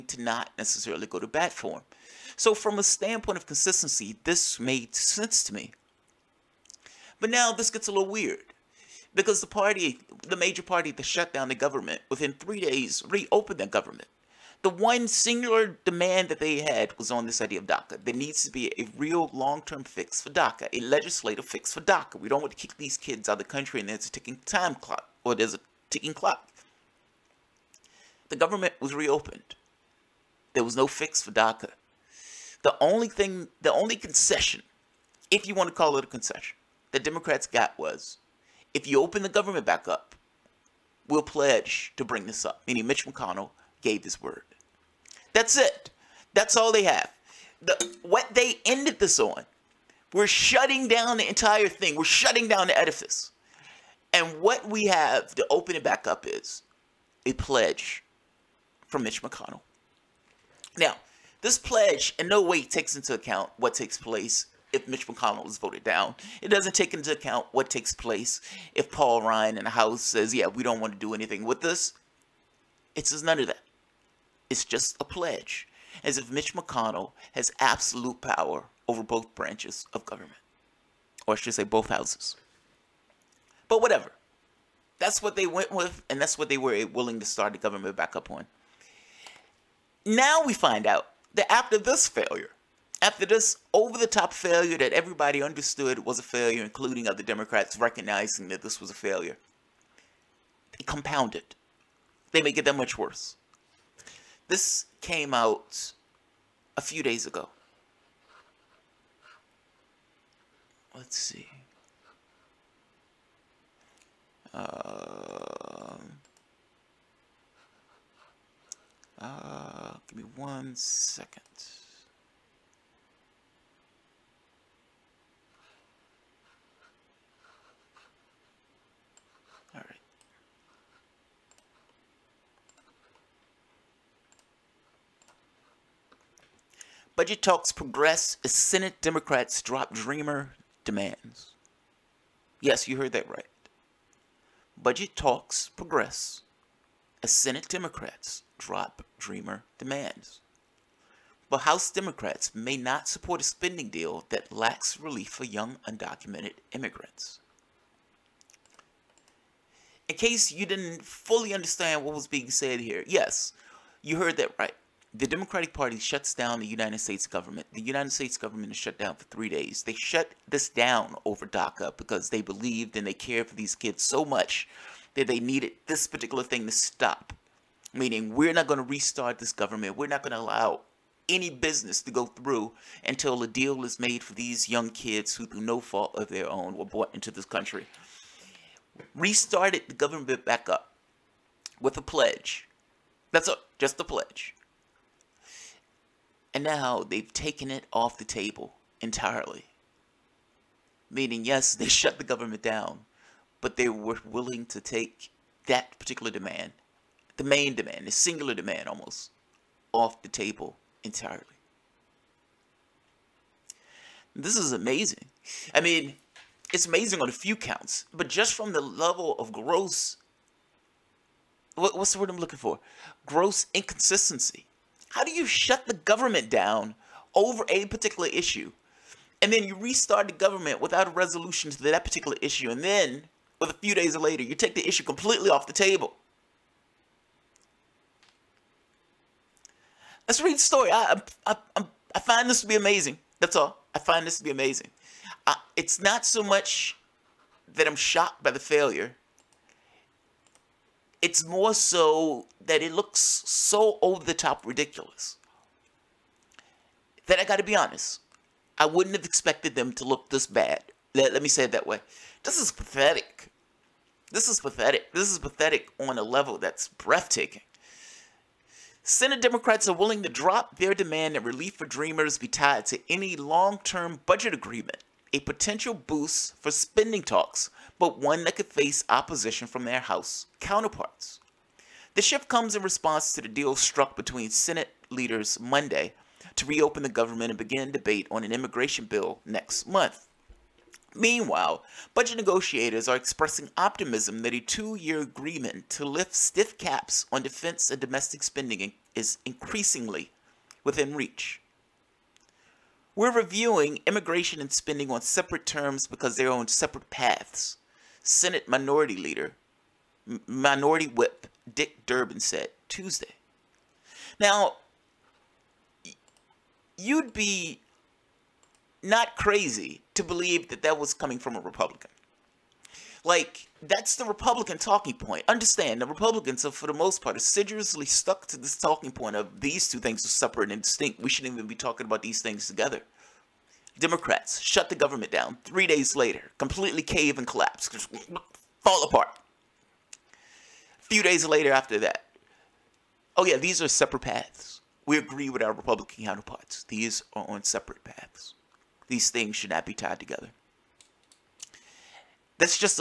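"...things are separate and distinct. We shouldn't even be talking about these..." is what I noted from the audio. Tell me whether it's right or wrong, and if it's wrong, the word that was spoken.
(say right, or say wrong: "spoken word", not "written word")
right.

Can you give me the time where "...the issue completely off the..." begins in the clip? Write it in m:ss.
3:54.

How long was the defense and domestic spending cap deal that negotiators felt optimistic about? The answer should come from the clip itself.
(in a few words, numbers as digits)
2 years.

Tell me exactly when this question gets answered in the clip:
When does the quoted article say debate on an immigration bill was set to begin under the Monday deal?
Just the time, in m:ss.
4:49.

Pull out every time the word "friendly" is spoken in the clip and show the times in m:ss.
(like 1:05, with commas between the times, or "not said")
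not said.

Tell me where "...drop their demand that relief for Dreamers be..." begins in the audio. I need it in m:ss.
4:30.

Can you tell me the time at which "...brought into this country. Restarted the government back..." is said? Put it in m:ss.
3:06.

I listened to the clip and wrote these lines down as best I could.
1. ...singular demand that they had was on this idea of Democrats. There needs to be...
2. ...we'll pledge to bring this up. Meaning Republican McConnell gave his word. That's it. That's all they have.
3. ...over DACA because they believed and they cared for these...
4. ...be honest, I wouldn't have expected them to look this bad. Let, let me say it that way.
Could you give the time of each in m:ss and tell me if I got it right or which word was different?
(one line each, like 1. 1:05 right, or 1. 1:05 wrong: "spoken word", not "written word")
1. 0:15 wrong: "DACA", not "Democrats"
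2. 0:41 wrong: "Mitch", not "Republican"
3. 2:51 right
4. 4:17 right.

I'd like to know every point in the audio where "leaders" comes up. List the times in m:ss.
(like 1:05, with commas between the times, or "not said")
4:45, 5:09.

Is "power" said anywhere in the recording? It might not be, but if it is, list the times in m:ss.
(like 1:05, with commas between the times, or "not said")
1:18.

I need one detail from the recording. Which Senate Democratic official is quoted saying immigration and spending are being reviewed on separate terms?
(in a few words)
Dick Durbin.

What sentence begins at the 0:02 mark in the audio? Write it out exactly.
So from a standpoint of consistency, this made sense to me.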